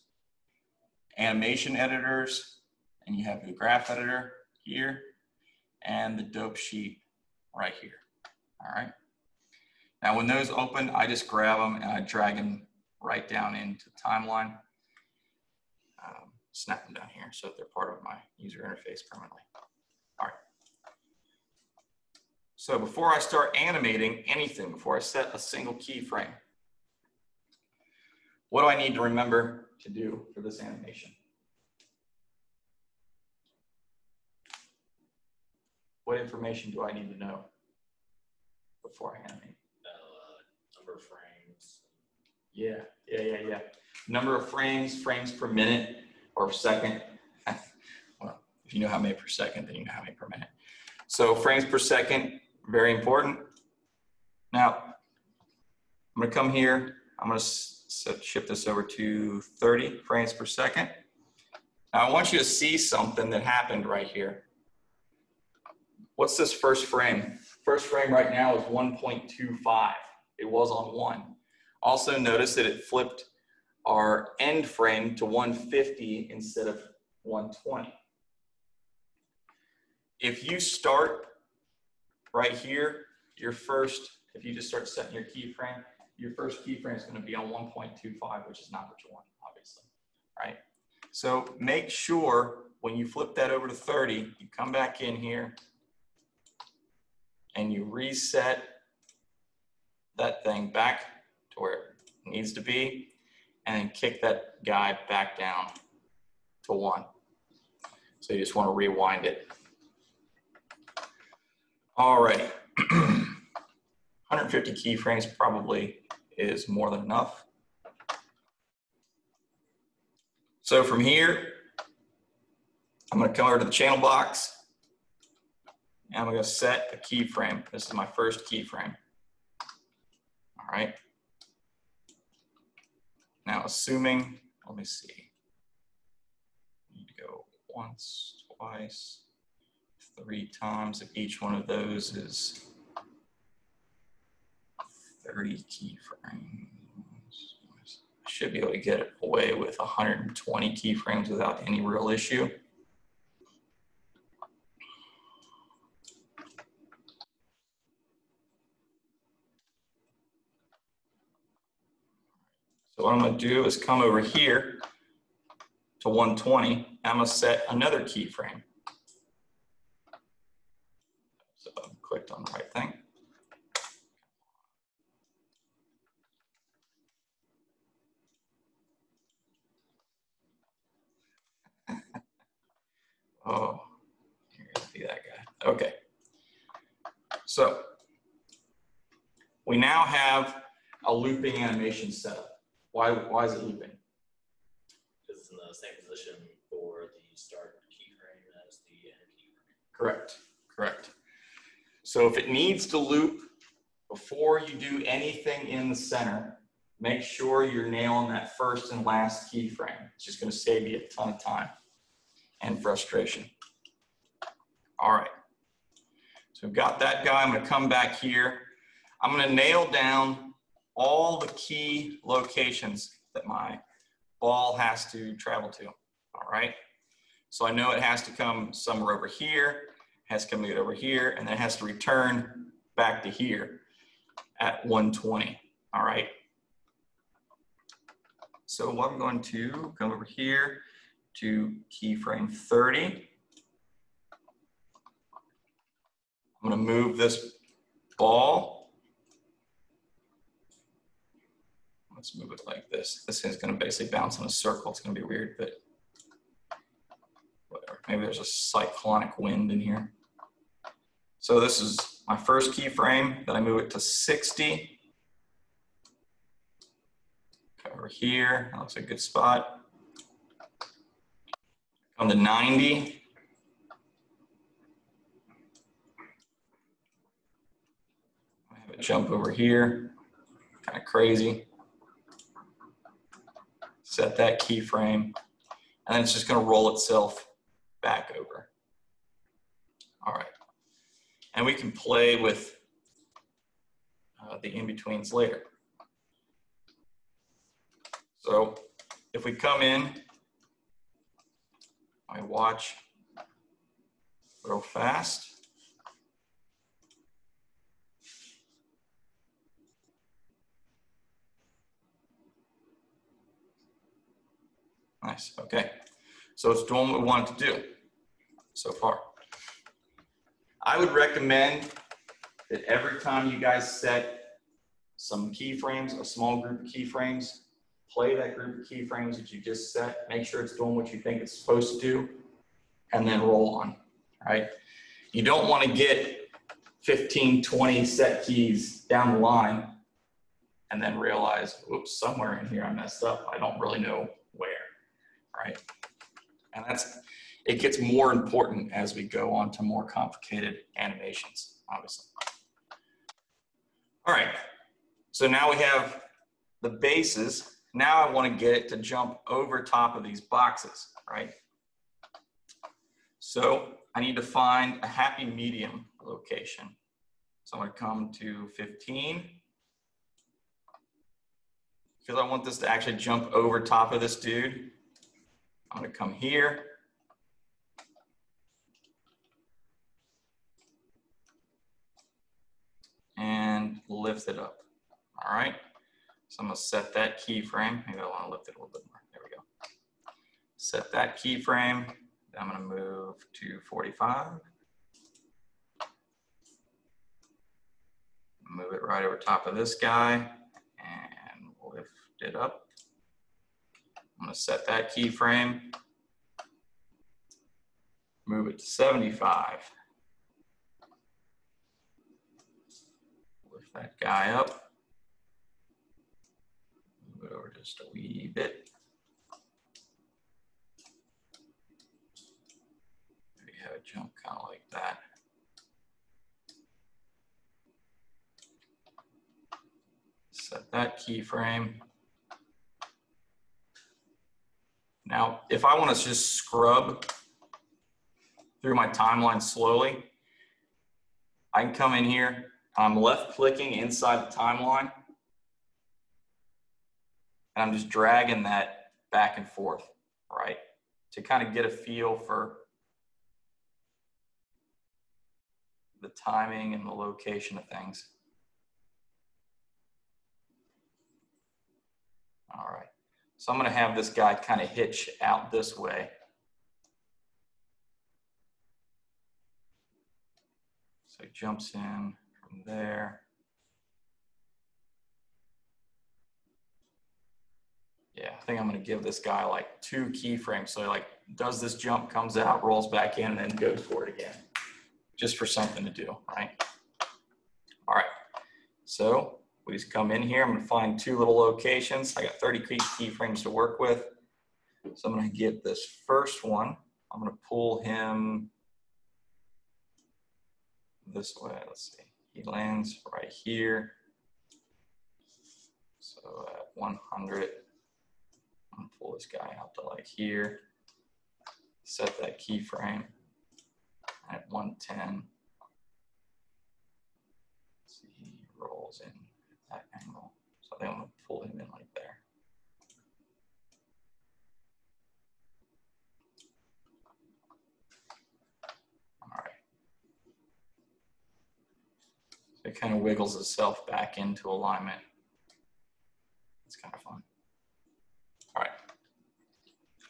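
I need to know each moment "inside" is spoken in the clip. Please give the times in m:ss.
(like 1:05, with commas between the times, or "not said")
7:23.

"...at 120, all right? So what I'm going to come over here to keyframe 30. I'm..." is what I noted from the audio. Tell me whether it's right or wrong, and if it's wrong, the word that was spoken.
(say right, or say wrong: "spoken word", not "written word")
right.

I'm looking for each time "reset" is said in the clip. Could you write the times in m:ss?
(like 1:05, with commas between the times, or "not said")
1:37.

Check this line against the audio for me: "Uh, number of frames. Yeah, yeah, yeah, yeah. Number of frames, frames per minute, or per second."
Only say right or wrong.
right.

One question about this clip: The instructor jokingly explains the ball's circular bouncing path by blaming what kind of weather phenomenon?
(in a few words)
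cyclonic wind.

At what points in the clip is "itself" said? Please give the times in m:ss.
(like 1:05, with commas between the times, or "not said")
4:46, 8:53.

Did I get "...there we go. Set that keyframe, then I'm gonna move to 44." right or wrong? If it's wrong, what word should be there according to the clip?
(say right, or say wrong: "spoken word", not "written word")
wrong: "45", not "44".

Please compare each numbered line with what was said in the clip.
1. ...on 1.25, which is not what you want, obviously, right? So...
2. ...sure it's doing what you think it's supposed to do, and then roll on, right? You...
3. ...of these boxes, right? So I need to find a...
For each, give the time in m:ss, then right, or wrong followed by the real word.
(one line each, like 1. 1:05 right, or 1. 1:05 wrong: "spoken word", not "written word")
1. 1:27 right
2. 5:30 right
3. 6:00 right.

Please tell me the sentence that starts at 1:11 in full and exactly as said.
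Also notice that it flipped our end frame to 150 instead of 120.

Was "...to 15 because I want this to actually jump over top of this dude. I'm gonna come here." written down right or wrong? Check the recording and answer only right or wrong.
right.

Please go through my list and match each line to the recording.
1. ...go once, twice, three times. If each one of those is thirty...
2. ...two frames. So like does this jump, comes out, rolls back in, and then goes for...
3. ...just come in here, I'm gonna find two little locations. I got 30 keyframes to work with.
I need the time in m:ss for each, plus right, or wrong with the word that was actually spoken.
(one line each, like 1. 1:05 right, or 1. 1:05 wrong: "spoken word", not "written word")
1. 2:17 right
2. 8:00 wrong: "keyframes", not "frames"
3. 8:09 right.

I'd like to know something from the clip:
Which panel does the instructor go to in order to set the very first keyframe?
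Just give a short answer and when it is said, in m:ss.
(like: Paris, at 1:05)
channel box, at 2:03.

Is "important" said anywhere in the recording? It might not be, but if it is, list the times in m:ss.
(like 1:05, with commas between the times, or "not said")
0:52, 5:48.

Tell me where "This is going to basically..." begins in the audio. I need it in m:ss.
4:13.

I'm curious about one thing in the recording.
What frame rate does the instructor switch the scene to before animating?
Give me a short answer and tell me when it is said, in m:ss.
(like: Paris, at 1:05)
30 frames per second, at 0:59.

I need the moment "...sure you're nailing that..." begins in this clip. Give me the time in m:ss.
3:27.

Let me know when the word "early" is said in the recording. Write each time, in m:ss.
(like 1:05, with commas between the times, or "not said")
not said.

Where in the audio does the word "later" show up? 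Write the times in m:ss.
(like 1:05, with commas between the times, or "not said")
4:55.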